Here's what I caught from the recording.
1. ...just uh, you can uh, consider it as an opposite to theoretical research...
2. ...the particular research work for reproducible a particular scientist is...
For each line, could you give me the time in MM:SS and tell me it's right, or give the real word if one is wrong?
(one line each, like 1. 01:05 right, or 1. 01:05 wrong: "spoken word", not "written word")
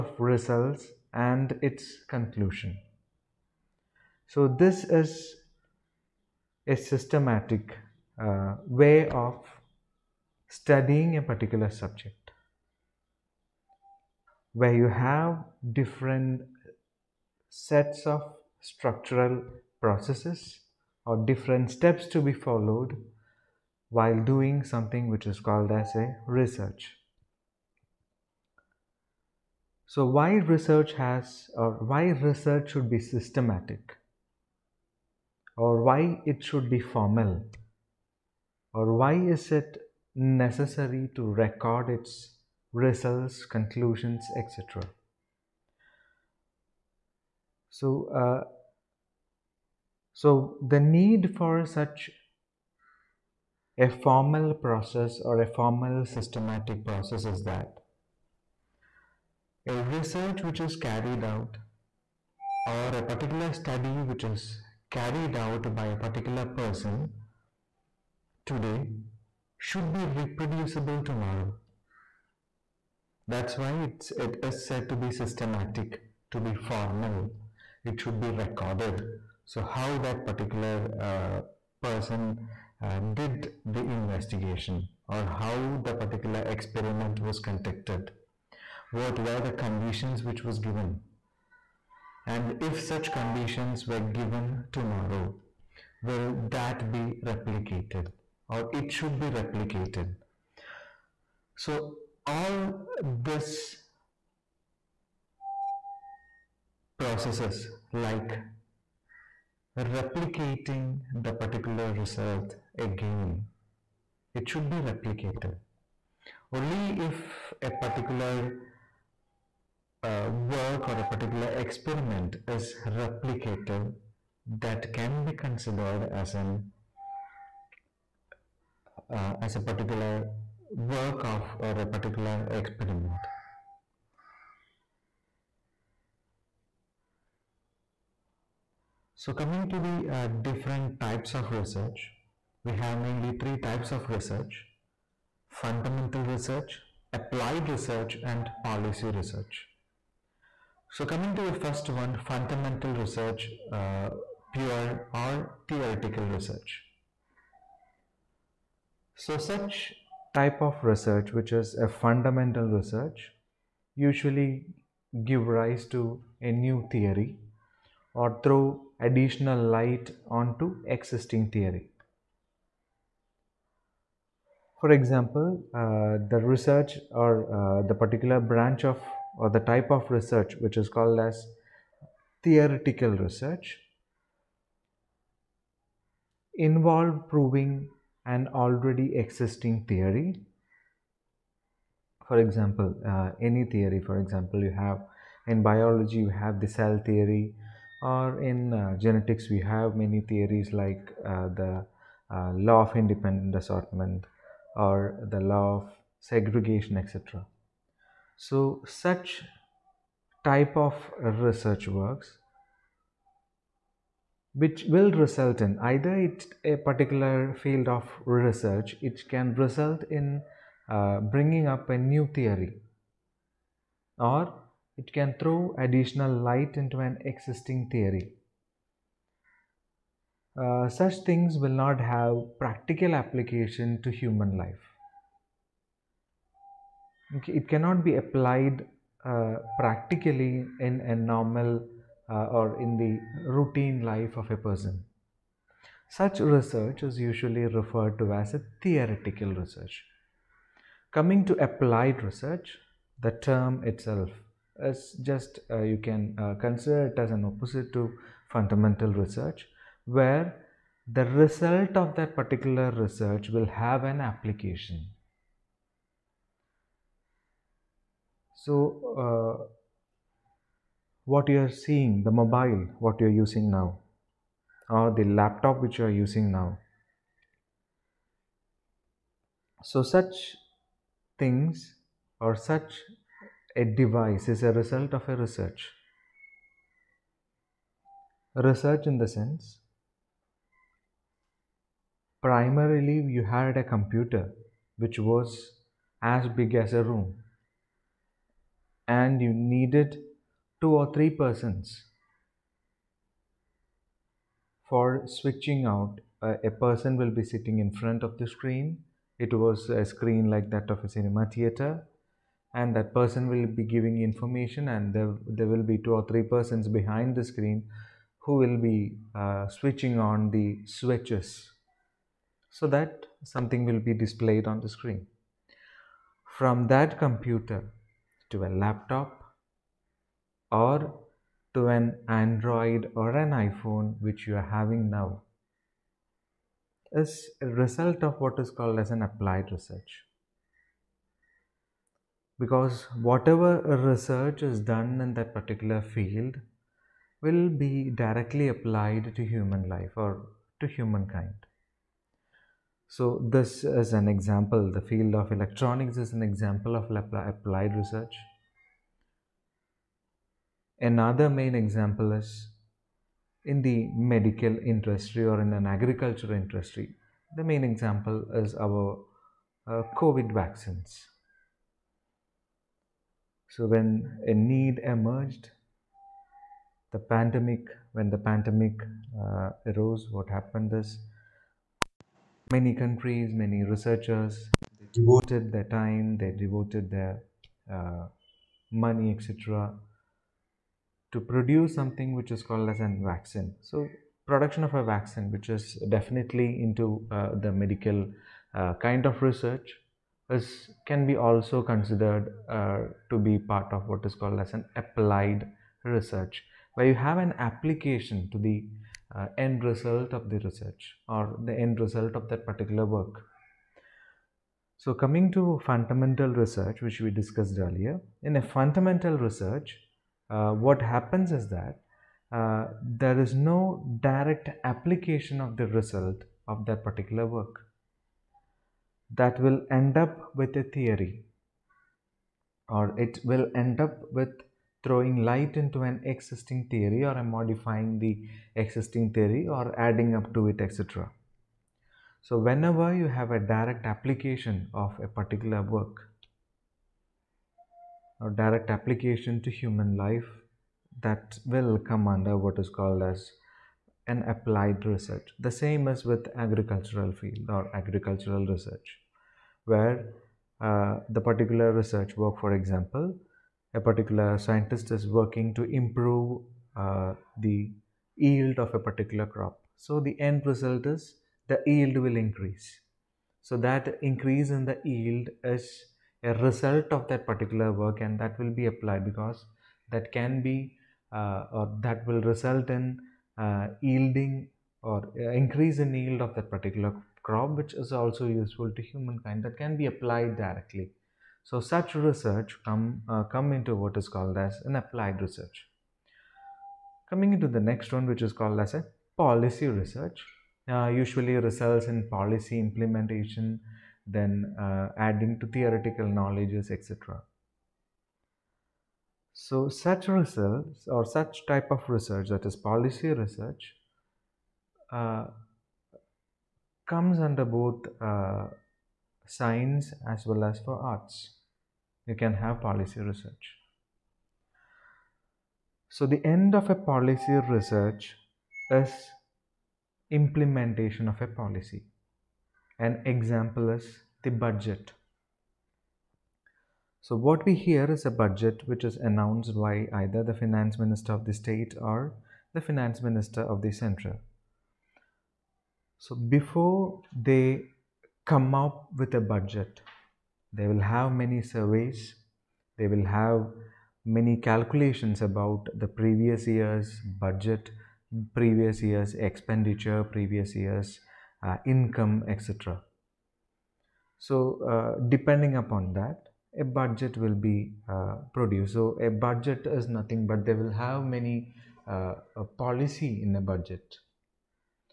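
1. 04:15 wrong: "fundamental", not "theoretical"
2. 07:41 wrong: "example", not "reproducible".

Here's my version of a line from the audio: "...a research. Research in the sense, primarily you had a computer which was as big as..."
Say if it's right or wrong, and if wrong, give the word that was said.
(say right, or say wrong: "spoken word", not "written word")
right.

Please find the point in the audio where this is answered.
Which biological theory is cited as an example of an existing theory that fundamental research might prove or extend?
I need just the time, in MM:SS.
03:16.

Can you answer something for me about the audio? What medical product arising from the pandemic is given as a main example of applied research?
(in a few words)
COVID vaccines.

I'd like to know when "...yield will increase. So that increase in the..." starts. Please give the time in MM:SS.
07:51.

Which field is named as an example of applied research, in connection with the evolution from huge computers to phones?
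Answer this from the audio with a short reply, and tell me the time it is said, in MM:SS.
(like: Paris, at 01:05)
Electronics, at 05:55.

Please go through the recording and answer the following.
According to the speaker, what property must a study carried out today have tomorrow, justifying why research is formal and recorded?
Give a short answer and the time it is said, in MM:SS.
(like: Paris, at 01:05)
Reproducible, at 01:10.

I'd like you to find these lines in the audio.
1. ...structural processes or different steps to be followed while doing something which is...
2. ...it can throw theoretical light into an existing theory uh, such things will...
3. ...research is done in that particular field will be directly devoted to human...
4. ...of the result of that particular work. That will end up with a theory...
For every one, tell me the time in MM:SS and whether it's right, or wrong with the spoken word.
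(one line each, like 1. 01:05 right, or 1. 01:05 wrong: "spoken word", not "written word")
1. 00:18 right
2. 03:44 wrong: "additional", not "theoretical"
3. 05:44 wrong: "applied", not "devoted"
4. 07:05 right.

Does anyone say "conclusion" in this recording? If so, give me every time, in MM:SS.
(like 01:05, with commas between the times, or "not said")
00:02, 00:43.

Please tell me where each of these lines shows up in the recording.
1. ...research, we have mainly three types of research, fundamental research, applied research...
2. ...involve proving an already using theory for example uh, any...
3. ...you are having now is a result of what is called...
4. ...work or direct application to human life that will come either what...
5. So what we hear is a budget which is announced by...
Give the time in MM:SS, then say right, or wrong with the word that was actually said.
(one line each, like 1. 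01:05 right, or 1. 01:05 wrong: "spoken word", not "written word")
1. 02:21 right
2. 03:06 wrong: "existing", not "using"
3. 05:34 right
4. 07:25 wrong: "under", not "either"
5. 08:57 right.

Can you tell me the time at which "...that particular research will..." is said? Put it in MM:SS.
04:22.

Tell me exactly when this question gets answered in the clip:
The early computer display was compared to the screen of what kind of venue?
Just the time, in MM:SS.
05:11.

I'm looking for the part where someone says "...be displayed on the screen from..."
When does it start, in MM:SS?
05:23.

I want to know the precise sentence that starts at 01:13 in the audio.
That's why it's, it is said to be systematic, to be formal.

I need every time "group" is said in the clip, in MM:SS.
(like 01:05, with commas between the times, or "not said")
not said.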